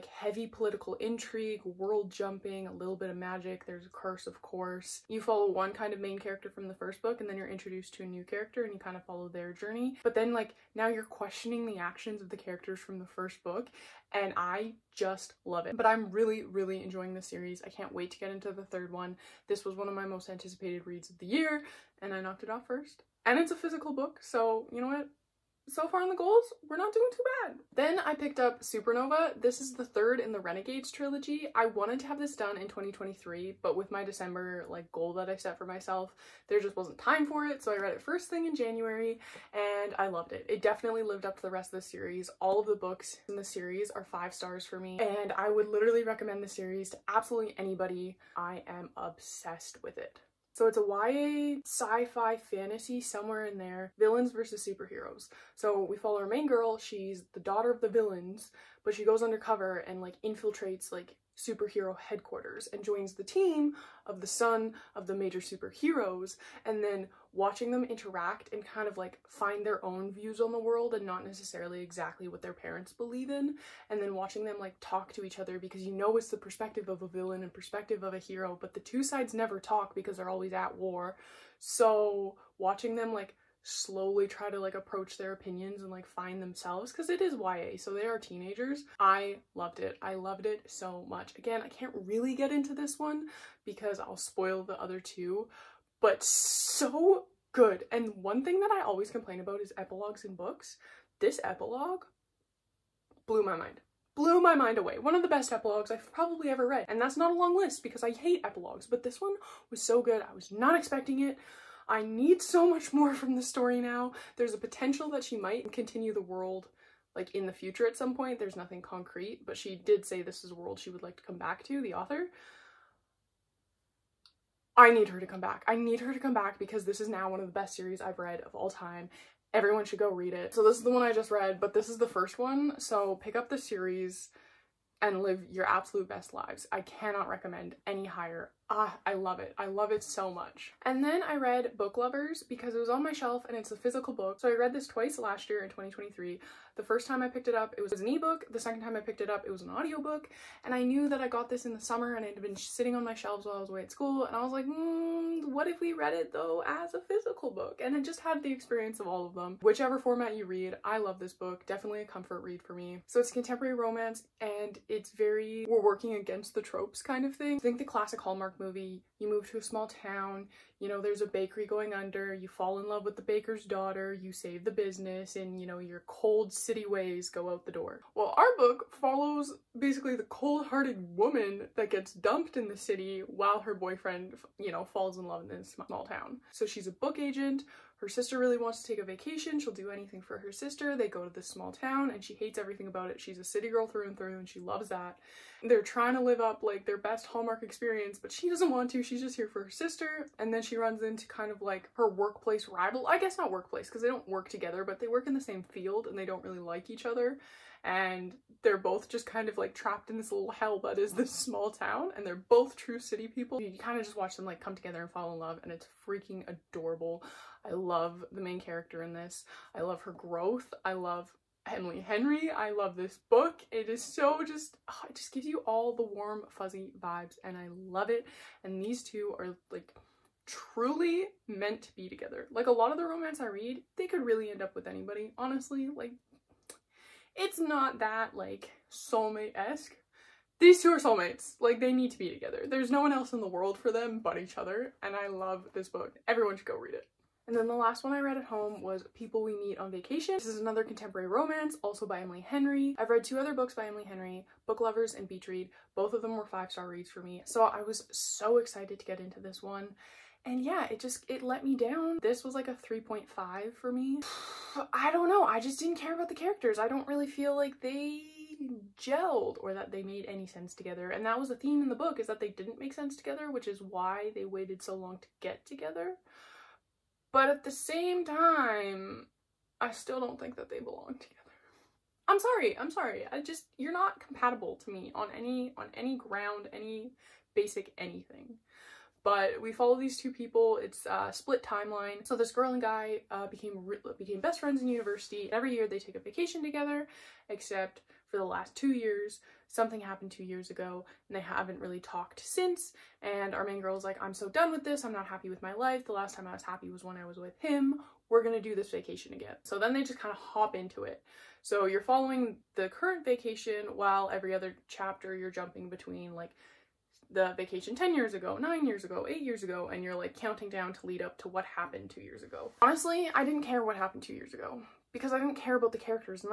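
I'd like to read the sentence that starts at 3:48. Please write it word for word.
And these two are like truly meant to be together.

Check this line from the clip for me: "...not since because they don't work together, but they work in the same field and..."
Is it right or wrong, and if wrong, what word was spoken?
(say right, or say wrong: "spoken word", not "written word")
wrong: "workplace", not "since".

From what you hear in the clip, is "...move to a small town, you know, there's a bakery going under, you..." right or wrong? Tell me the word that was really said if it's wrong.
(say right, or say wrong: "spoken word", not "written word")
right.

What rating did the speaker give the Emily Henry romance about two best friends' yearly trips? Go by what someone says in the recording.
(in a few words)
3.5.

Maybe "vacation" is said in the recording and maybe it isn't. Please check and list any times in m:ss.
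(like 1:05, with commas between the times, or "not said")
3:09, 4:09, 4:56, 5:08, 5:13, 5:17.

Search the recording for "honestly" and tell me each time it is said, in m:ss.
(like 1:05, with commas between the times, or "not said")
3:55, 5:22.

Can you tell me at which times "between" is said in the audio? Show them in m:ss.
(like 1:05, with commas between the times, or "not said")
5:15.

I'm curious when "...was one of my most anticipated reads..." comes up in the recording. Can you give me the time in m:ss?
0:19.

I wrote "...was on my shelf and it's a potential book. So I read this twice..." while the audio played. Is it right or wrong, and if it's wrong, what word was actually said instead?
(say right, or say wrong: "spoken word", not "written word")
wrong: "physical", not "potential".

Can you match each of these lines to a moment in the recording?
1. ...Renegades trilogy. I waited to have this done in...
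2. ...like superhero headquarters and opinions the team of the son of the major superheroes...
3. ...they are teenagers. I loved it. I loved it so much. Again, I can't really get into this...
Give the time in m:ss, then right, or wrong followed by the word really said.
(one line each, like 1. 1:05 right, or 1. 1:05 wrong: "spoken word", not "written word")
1. 0:30 wrong: "wanted", not "waited"
2. 1:00 wrong: "joins", not "opinions"
3. 1:27 right.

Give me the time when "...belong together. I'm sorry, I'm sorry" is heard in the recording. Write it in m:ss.
4:40.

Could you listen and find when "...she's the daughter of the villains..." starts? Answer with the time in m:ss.
0:56.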